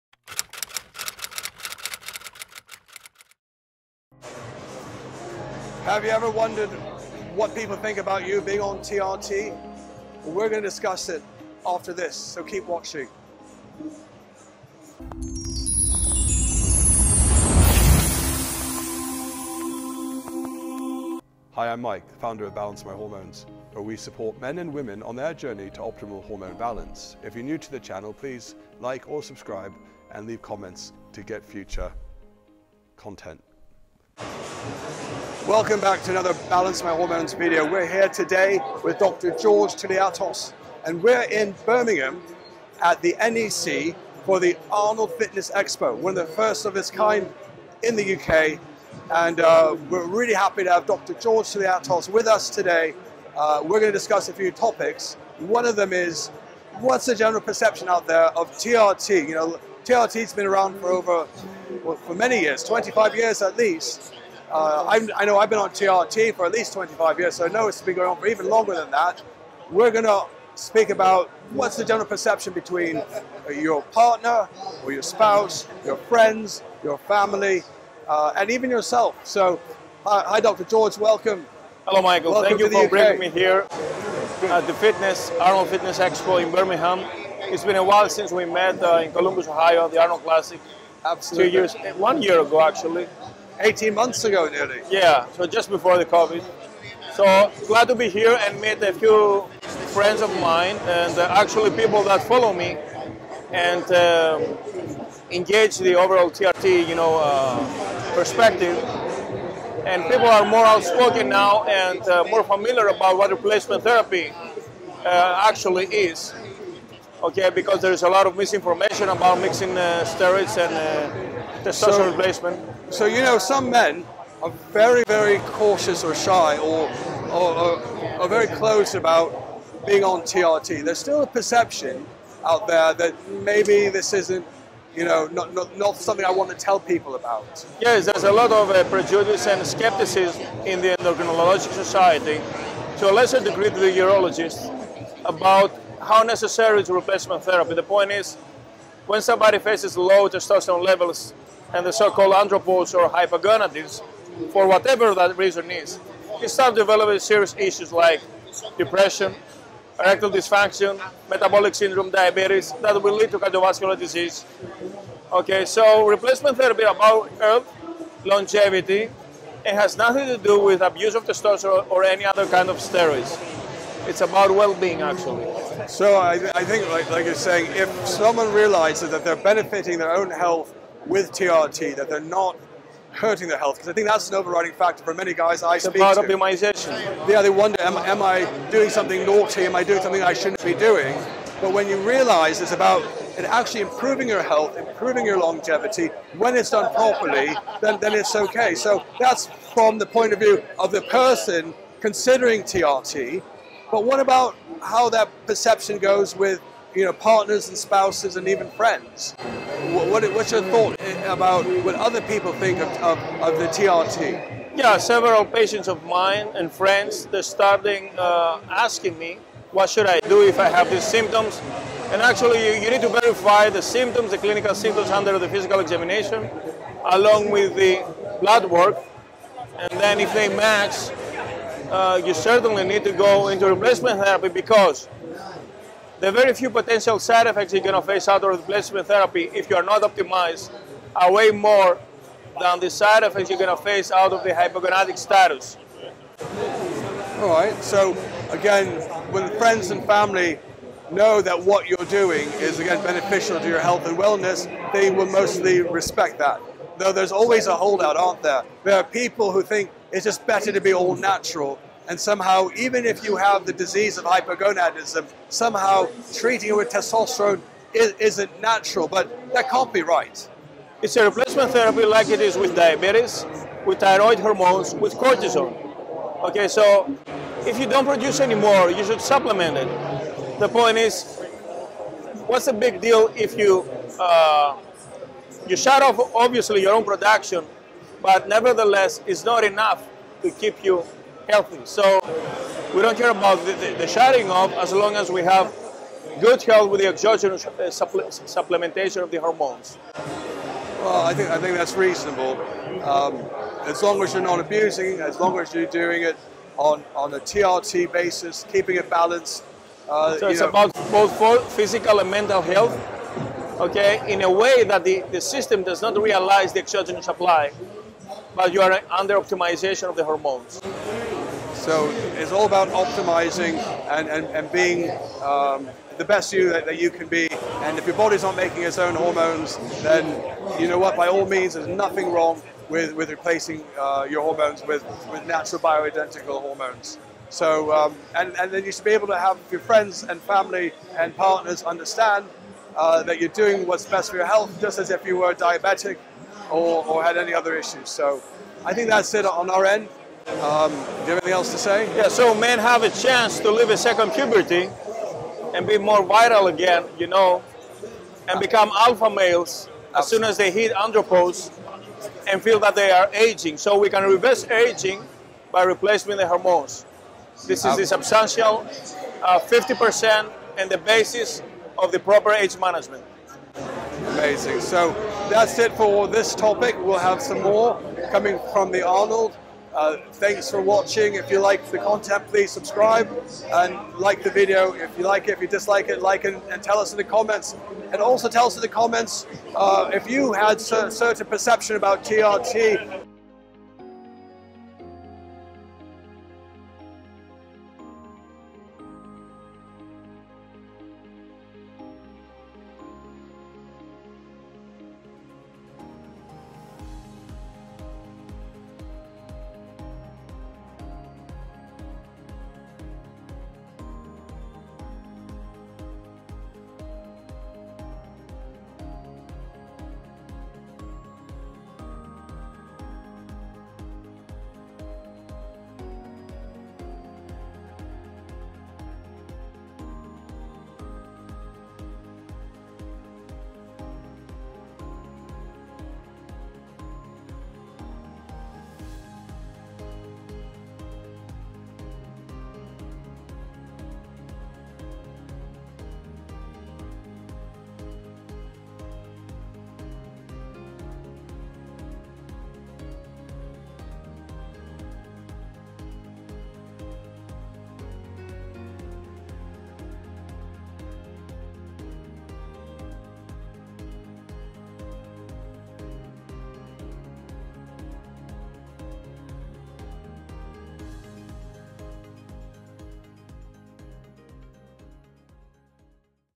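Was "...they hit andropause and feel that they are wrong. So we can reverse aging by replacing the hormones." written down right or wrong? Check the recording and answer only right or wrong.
wrong.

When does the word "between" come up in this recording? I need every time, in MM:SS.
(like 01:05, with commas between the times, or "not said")
01:12.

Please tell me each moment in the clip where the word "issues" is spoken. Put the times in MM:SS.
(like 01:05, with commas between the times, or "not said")
02:37, 05:47.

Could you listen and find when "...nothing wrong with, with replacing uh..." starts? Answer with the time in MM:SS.
05:31.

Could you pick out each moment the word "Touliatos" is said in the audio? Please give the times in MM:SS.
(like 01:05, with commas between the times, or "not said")
00:39, 00:51.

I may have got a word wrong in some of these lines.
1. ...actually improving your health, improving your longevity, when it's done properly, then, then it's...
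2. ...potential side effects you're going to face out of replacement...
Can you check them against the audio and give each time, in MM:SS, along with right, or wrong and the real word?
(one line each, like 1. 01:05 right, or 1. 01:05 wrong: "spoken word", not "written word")
1. 03:13 right
2. 03:56 right.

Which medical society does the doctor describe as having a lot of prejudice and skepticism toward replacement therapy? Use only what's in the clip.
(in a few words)
endocrinology society.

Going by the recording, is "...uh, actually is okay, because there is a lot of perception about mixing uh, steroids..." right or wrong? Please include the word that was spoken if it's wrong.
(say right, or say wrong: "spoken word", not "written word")
wrong: "misinformation", not "perception".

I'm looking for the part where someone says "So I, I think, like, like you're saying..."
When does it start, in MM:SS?
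02:55.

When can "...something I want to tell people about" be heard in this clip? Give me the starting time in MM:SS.
02:15.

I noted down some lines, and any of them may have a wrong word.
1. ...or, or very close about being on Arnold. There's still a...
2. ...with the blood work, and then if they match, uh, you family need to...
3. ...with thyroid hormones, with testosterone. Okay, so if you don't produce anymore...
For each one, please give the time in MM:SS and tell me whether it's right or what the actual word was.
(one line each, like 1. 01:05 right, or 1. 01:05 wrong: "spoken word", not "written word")
1. 02:07 wrong: "TRT", not "Arnold"
2. 03:47 wrong: "certainly", not "family"
3. 04:33 wrong: "cortisone", not "testosterone".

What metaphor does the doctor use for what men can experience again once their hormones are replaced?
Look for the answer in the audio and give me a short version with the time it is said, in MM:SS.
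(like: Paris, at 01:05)
second puberty, at 05:53.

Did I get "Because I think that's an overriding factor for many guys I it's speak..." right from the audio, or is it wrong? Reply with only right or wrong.
right.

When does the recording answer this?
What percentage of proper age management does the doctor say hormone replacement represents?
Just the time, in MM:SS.
06:09.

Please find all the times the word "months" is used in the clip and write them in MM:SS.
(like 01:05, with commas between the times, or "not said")
01:33.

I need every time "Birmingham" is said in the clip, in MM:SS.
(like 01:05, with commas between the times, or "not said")
00:41, 01:26.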